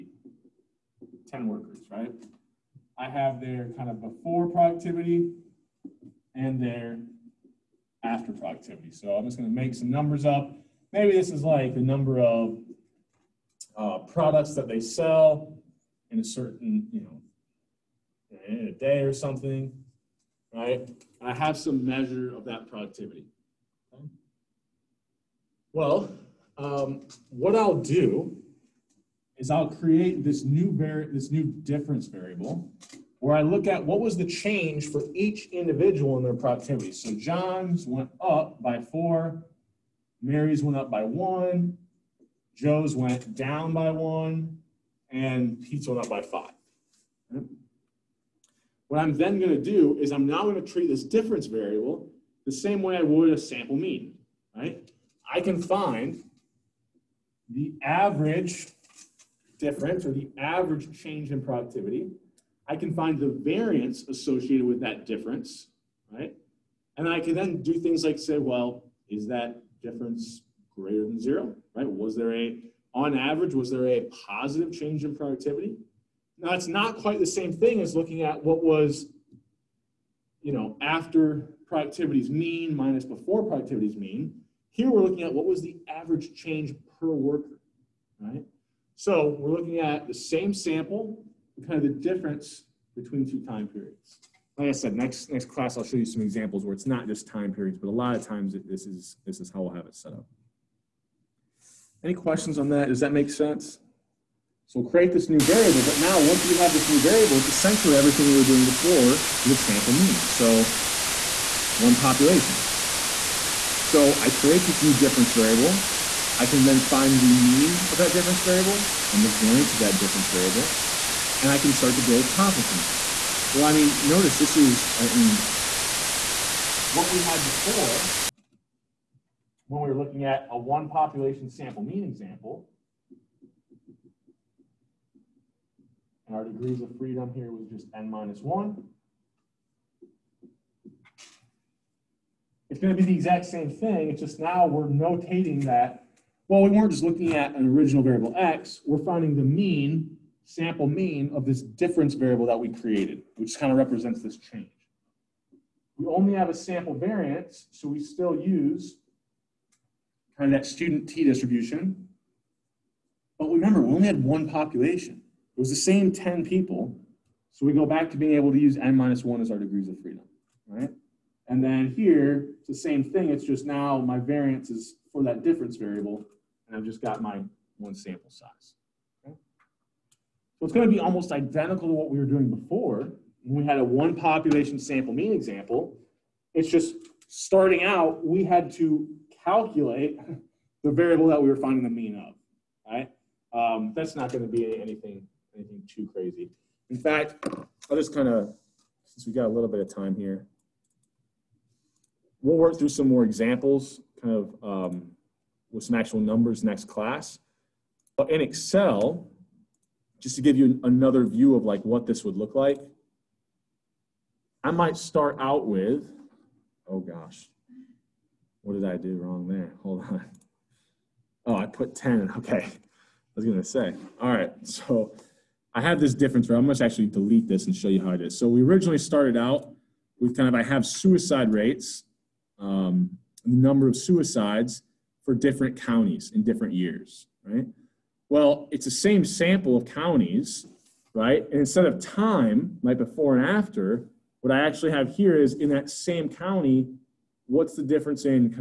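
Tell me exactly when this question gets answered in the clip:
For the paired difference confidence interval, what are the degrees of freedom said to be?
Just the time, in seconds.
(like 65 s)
168 s.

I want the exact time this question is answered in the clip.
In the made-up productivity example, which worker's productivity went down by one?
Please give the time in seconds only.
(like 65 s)
42 s.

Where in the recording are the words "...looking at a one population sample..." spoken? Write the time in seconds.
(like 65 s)
129 s.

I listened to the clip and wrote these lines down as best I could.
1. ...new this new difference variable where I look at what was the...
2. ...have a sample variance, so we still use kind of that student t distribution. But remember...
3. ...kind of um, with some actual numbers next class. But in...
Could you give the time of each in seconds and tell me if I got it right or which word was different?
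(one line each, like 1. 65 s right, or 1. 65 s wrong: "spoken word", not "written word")
1. 30 s right
2. 156 s right
3. 204 s right.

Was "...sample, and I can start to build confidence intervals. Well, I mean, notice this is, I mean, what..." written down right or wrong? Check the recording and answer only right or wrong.
wrong.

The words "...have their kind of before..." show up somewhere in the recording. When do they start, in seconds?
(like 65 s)
3 s.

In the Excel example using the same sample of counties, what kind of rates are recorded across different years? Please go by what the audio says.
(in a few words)
Suicide rates.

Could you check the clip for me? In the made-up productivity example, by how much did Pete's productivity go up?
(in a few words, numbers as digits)
5.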